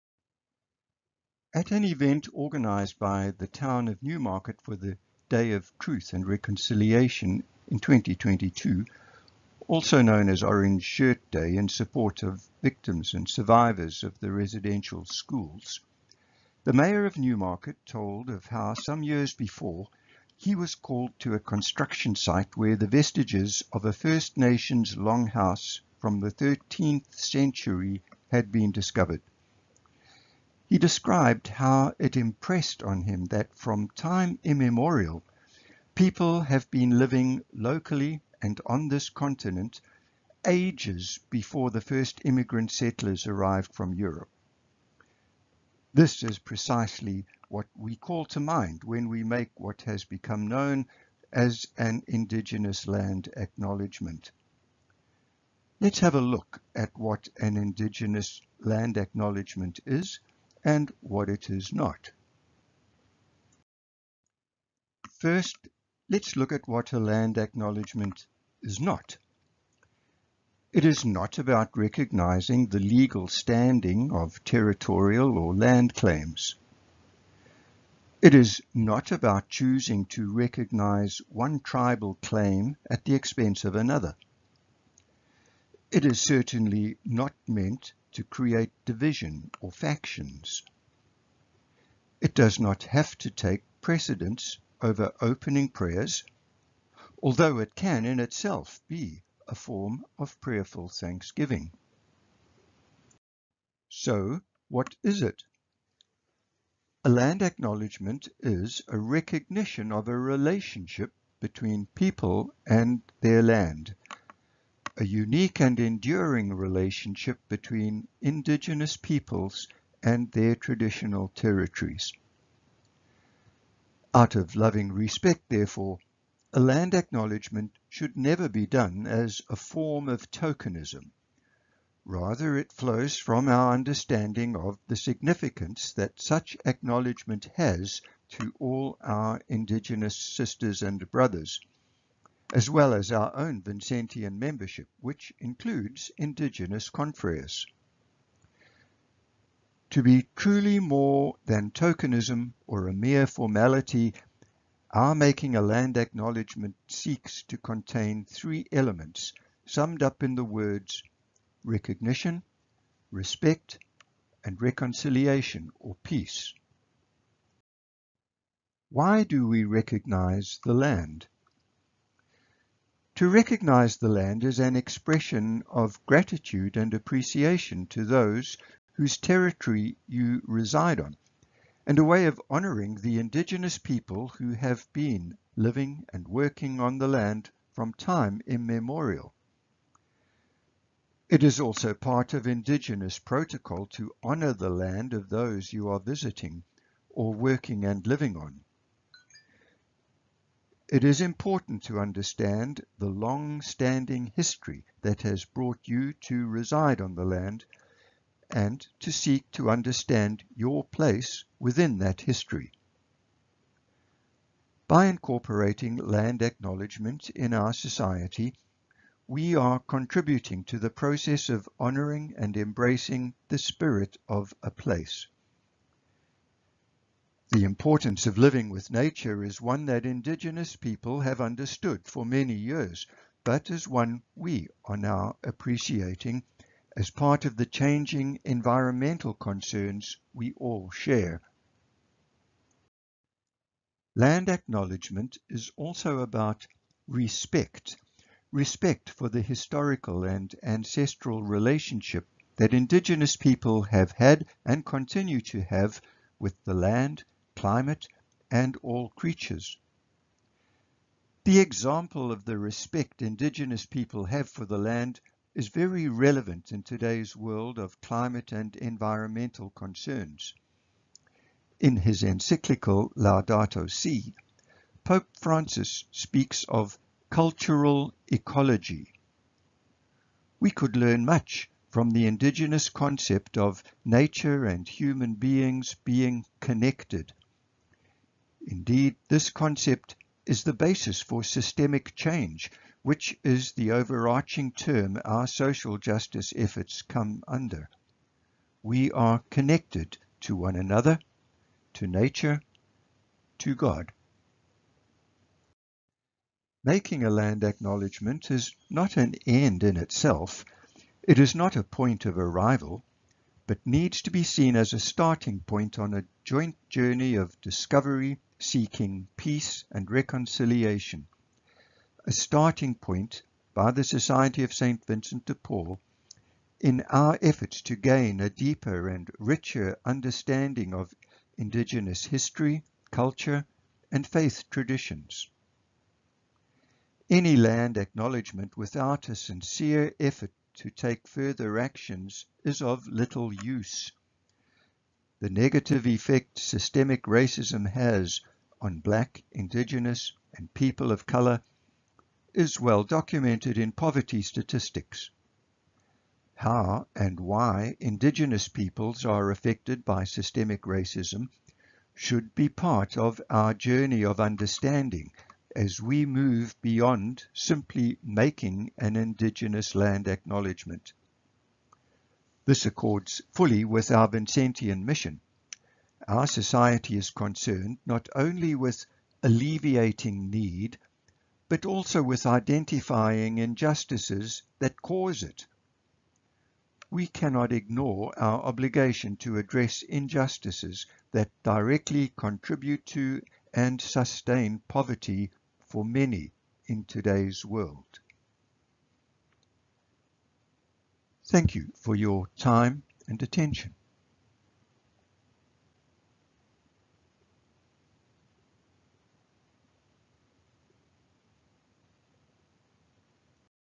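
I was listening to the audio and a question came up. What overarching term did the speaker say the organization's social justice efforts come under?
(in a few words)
systemic change.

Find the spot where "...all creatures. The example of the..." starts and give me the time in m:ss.
4:18.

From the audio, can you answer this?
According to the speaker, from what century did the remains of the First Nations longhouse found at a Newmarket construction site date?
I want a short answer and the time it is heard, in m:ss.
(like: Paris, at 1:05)
13th century, at 0:26.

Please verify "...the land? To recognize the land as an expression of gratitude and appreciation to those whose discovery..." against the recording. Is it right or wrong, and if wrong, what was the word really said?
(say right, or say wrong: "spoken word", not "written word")
wrong: "territory", not "discovery".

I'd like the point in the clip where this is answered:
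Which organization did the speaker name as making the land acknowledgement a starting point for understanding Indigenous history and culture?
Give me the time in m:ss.
5:24.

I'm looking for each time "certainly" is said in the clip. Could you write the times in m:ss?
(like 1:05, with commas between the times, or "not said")
1:26.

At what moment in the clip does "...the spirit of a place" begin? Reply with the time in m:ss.
3:43.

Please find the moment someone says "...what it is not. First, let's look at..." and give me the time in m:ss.
1:01.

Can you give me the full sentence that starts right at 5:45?
The negative effect systemic racism has on black, indigenous, and people of color is well documented in poverty statistics.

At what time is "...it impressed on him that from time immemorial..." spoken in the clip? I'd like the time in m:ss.
0:31.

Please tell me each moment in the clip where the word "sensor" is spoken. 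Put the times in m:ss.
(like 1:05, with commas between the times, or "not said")
not said.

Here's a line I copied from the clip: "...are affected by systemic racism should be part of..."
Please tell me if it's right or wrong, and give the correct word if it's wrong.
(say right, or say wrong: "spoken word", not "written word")
right.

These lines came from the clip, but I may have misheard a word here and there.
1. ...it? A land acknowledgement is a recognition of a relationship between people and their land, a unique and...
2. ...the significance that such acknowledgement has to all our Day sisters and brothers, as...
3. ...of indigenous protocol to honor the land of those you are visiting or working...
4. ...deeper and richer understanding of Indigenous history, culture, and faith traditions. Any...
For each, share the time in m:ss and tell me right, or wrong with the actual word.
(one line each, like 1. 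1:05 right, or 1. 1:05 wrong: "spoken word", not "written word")
1. 1:45 right
2. 2:14 wrong: "Indigenous", not "Day"
3. 3:12 right
4. 5:28 right.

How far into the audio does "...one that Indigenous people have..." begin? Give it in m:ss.
3:49.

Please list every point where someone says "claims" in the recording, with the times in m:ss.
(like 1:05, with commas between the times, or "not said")
1:15, 1:22.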